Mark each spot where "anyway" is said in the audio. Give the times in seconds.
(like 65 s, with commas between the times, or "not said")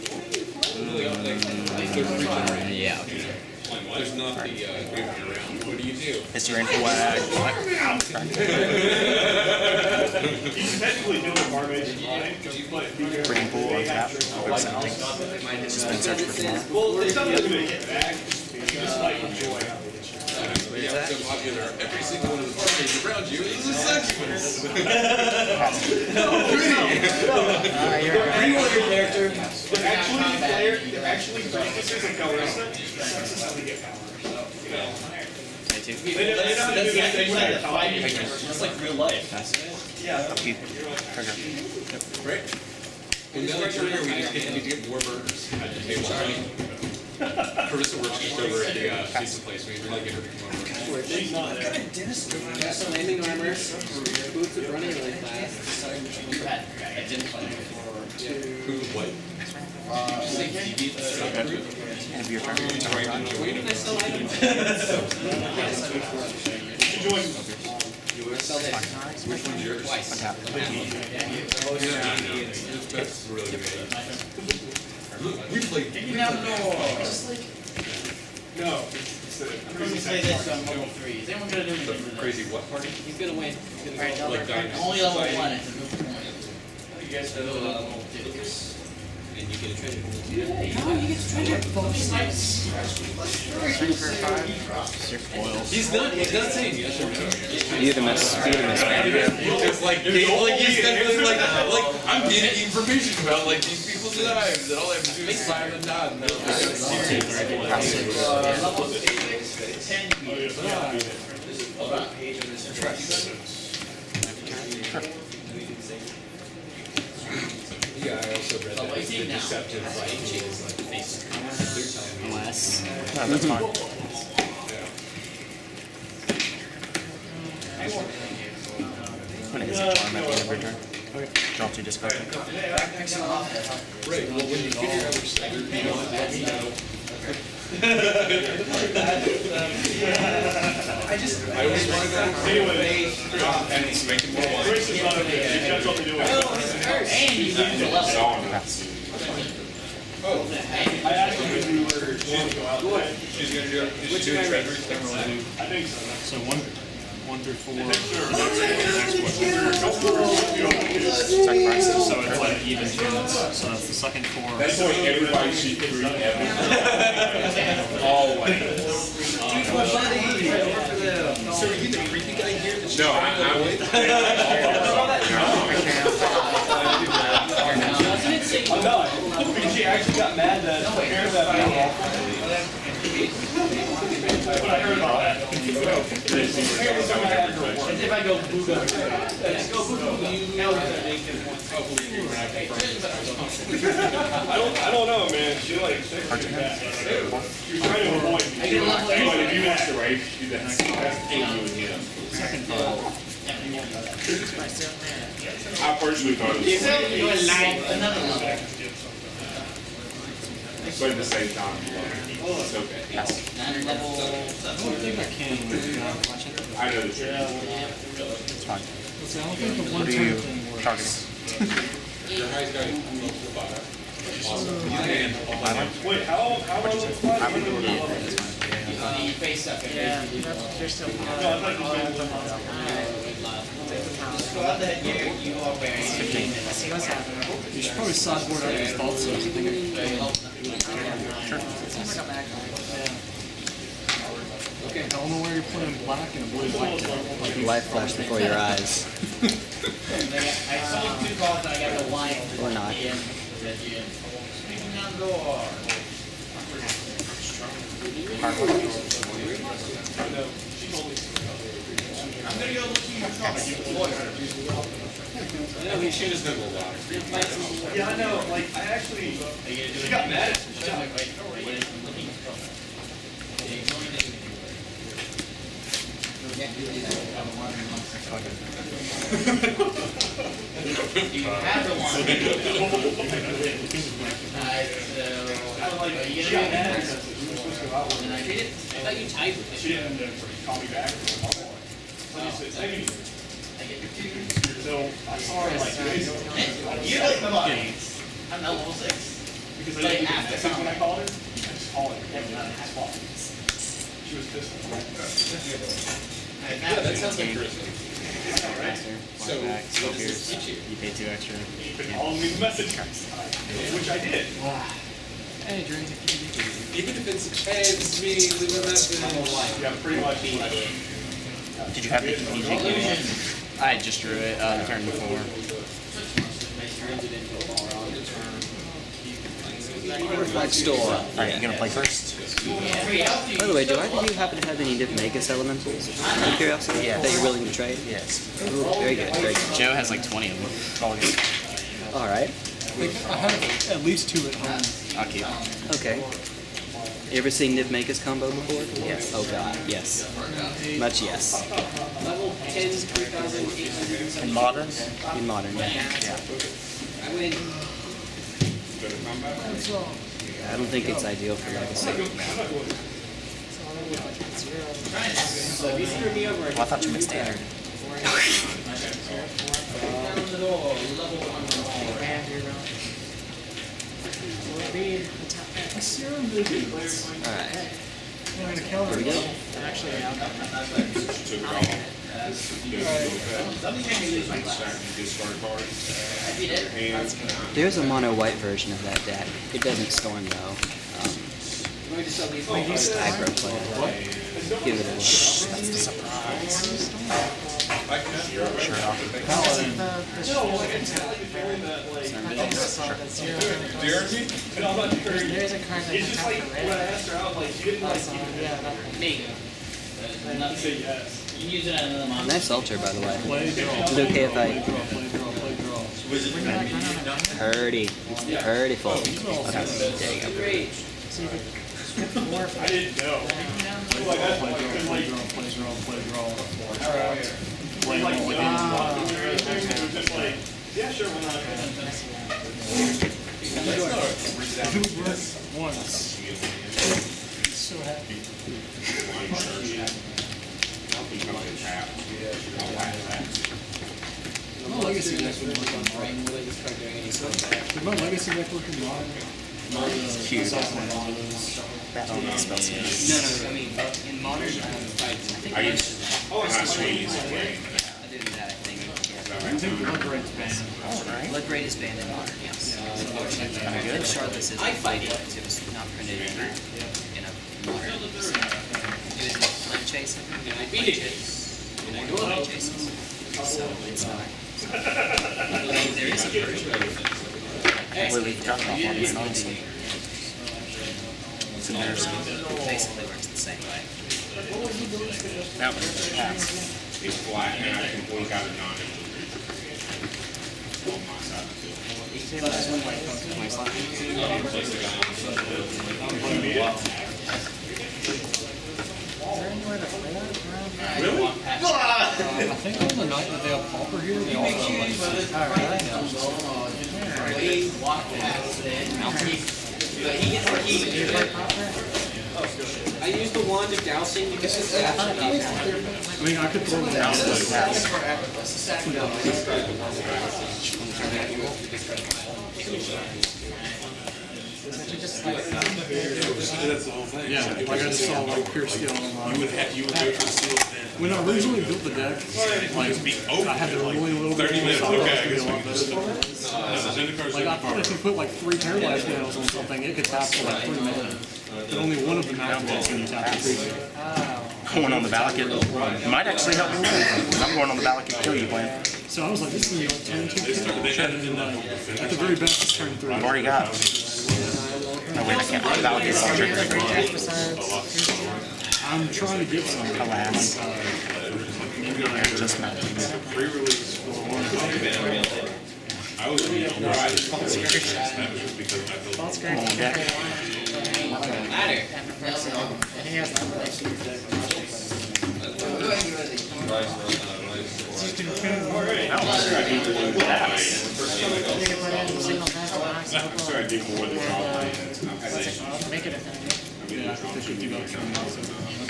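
142 s, 198 s.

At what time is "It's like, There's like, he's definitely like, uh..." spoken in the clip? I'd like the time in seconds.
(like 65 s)
98 s.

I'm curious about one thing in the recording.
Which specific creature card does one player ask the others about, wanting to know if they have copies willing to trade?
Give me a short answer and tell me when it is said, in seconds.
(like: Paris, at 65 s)
Nivmagus elementals, at 334 s.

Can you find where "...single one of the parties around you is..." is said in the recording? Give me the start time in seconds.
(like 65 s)
22 s.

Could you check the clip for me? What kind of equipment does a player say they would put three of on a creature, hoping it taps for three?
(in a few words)
paralyzed nails.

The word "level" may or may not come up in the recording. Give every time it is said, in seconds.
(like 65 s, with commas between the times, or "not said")
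298 s, 352 s.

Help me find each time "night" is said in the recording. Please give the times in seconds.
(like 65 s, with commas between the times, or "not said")
302 s, 503 s.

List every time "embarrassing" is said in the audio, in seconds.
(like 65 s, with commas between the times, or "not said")
481 s.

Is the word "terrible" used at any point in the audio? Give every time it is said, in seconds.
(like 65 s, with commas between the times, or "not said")
not said.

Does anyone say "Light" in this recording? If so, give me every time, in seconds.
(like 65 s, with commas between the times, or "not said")
247 s.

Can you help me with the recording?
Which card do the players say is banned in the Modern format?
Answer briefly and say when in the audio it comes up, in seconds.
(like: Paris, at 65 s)
Bloodbraid, at 460 s.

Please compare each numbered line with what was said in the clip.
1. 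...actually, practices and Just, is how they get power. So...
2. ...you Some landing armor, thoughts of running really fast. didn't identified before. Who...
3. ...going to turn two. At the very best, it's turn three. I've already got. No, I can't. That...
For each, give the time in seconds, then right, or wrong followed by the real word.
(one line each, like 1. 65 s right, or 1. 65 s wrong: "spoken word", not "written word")
1. 31 s wrong: "Calrissa", not "Just"
2. 52 s wrong: "boots", not "thoughts"
3. 549 s right.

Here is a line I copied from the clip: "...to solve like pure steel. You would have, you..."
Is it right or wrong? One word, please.
right.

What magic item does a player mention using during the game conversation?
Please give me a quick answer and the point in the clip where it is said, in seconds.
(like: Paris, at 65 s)
wand of dousing, at 513 s.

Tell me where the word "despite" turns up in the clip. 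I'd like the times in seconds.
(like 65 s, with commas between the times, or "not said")
not said.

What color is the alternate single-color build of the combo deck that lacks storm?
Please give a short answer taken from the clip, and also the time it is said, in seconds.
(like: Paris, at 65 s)
mono white, at 388 s.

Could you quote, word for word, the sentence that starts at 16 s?
Well, it's something to get back.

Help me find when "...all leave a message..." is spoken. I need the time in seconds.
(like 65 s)
312 s.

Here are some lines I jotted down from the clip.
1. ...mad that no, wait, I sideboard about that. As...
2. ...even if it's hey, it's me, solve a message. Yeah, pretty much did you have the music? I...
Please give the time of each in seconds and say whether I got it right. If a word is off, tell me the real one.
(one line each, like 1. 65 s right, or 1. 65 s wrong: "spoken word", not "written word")
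1. 180 s wrong: "heard", not "sideboard"
2. 316 s wrong: "leave", not "solve".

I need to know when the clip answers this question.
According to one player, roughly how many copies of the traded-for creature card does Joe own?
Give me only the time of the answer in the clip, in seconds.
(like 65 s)
340 s.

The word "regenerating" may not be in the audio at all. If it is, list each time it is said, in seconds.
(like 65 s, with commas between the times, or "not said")
1 s.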